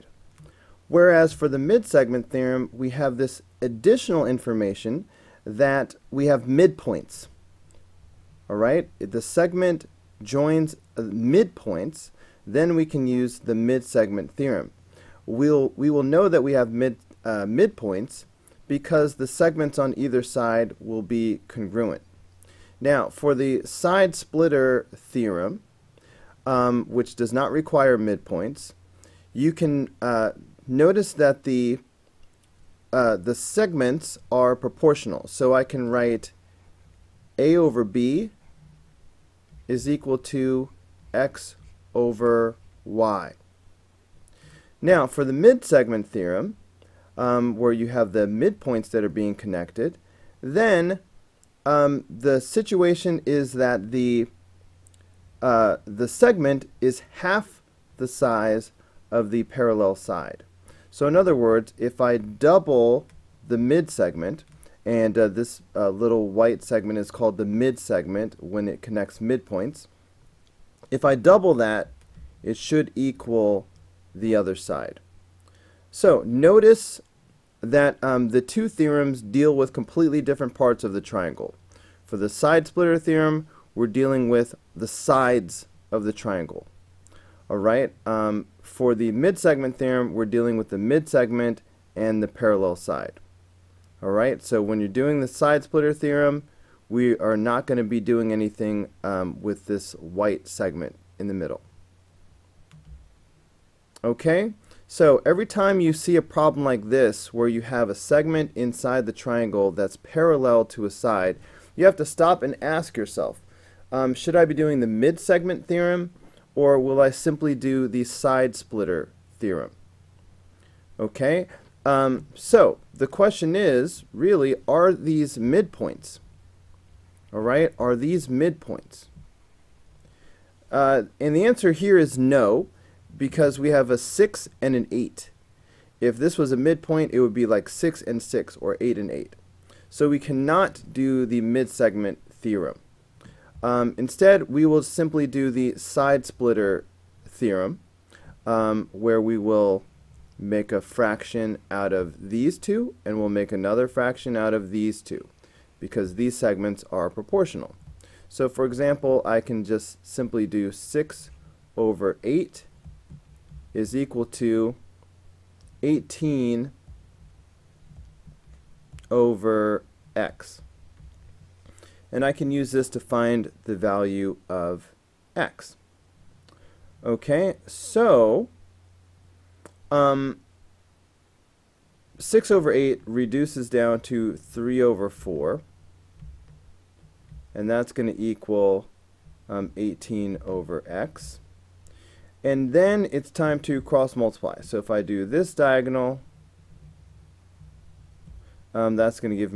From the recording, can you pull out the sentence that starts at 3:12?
And then it's time to cross multiply.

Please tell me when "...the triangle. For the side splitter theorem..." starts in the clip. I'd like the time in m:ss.
1:20.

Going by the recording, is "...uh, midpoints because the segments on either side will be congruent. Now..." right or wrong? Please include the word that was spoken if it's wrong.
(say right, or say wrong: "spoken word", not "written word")
right.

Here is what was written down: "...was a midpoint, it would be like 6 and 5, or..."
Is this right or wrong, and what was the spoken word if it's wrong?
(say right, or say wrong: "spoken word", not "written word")
wrong: "6", not "5".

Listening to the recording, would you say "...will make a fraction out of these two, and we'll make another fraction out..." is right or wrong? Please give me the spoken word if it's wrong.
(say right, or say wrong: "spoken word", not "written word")
right.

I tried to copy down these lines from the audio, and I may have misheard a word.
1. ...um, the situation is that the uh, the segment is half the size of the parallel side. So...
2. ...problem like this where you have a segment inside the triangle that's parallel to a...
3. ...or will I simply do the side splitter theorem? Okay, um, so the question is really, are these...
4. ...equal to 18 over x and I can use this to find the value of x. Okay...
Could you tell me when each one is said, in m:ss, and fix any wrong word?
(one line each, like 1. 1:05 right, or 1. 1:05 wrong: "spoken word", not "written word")
1. 0:51 right
2. 1:46 right
3. 1:56 right
4. 2:43 right.